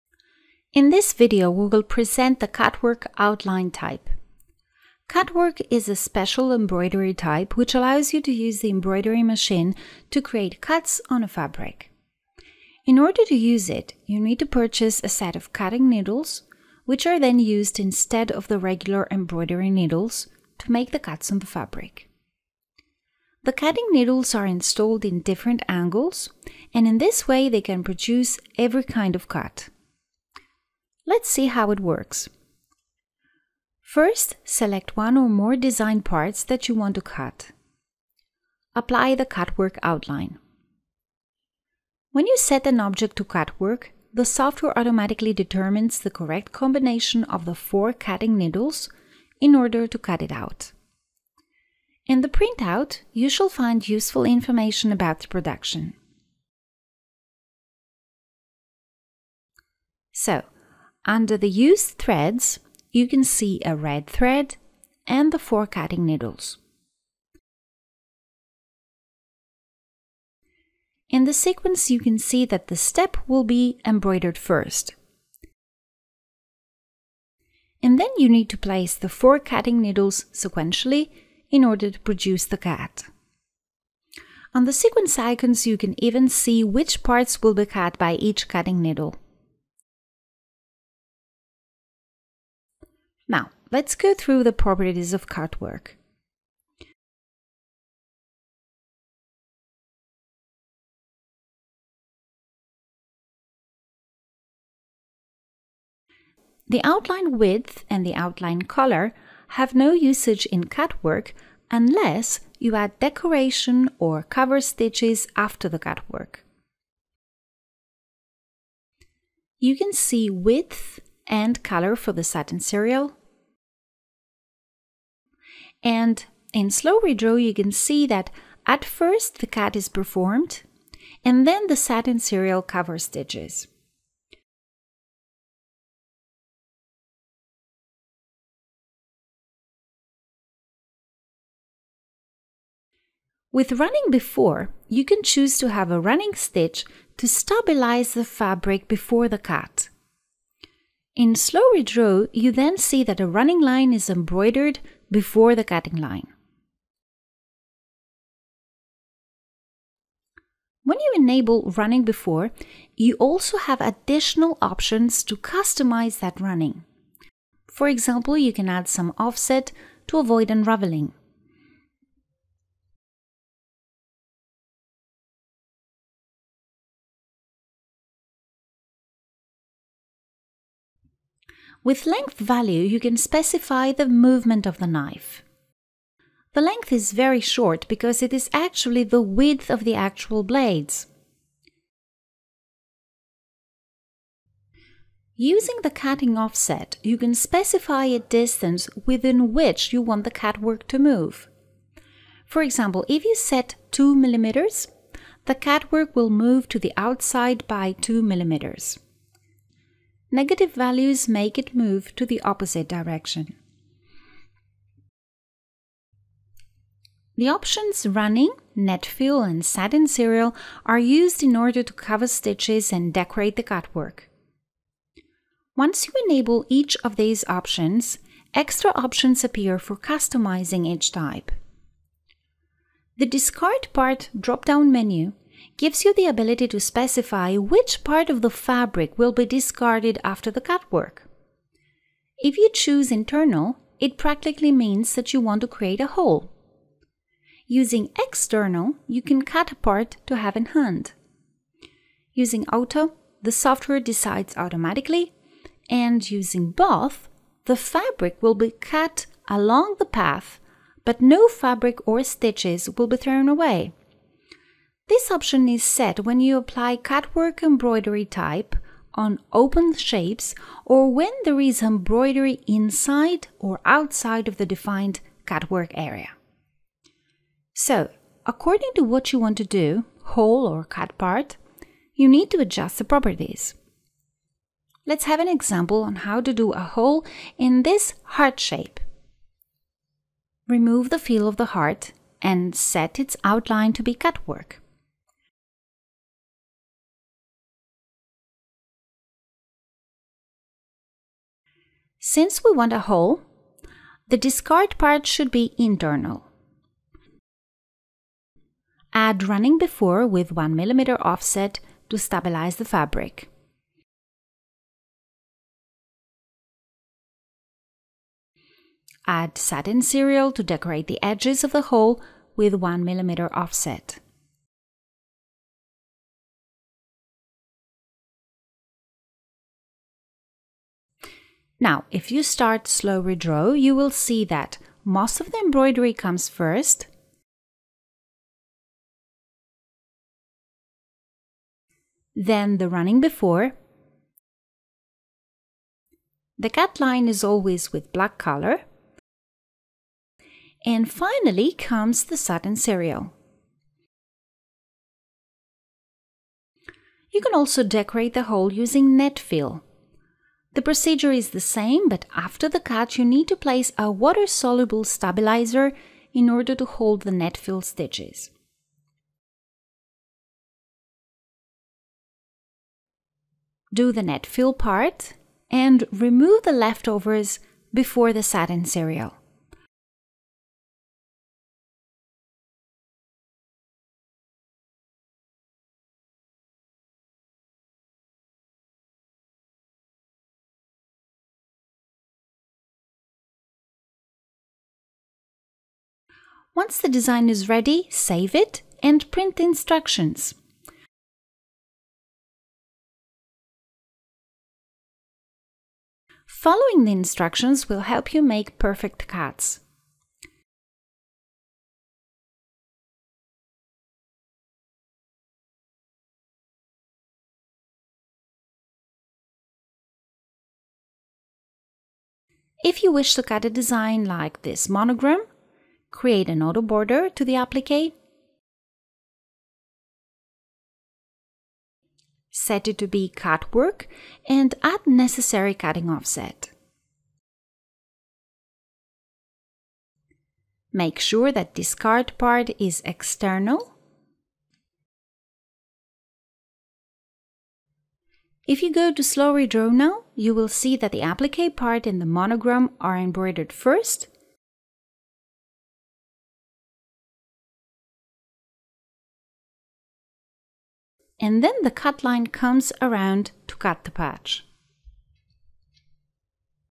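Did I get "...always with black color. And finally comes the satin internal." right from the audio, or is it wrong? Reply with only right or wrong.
wrong.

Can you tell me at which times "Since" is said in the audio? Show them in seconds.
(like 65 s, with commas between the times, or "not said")
302 s.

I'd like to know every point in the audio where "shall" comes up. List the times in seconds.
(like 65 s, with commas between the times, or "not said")
53 s.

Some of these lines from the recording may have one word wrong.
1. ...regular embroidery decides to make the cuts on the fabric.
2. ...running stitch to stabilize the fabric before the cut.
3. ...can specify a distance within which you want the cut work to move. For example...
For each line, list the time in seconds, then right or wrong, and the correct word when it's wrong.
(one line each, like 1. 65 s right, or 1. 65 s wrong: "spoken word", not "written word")
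1. 18 s wrong: "needles", not "decides"
2. 145 s right
3. 197 s right.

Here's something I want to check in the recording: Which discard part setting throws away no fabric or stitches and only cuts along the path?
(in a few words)
both.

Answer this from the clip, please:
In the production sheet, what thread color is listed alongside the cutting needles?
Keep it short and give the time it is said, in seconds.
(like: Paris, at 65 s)
red, at 63 s.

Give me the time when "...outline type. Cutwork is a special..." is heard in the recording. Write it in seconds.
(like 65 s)
3 s.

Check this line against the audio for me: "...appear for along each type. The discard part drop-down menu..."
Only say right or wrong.
wrong.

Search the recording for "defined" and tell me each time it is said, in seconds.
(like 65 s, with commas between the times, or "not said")
274 s.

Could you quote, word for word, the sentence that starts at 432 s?
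Set it to be cut work and add necessary cutting offset.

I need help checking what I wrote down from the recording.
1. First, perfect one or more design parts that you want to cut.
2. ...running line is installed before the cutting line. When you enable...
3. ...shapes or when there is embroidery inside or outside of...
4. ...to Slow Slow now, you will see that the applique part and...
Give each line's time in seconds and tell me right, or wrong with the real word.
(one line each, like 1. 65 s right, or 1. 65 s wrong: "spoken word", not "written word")
1. 33 s wrong: "select", not "perfect"
2. 153 s wrong: "embroidered", not "installed"
3. 269 s right
4. 449 s wrong: "Redraw", not "Slow".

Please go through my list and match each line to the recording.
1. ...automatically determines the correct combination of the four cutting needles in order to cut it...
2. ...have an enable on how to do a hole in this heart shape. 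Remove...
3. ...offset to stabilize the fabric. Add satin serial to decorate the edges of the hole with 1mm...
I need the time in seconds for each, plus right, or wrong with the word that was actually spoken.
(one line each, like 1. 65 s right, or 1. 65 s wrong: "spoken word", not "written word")
1. 44 s right
2. 285 s wrong: "example", not "enable"
3. 311 s right.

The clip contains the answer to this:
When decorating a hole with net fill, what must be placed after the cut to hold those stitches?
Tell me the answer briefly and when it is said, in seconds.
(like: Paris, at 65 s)
water-soluble stabilizer, at 364 s.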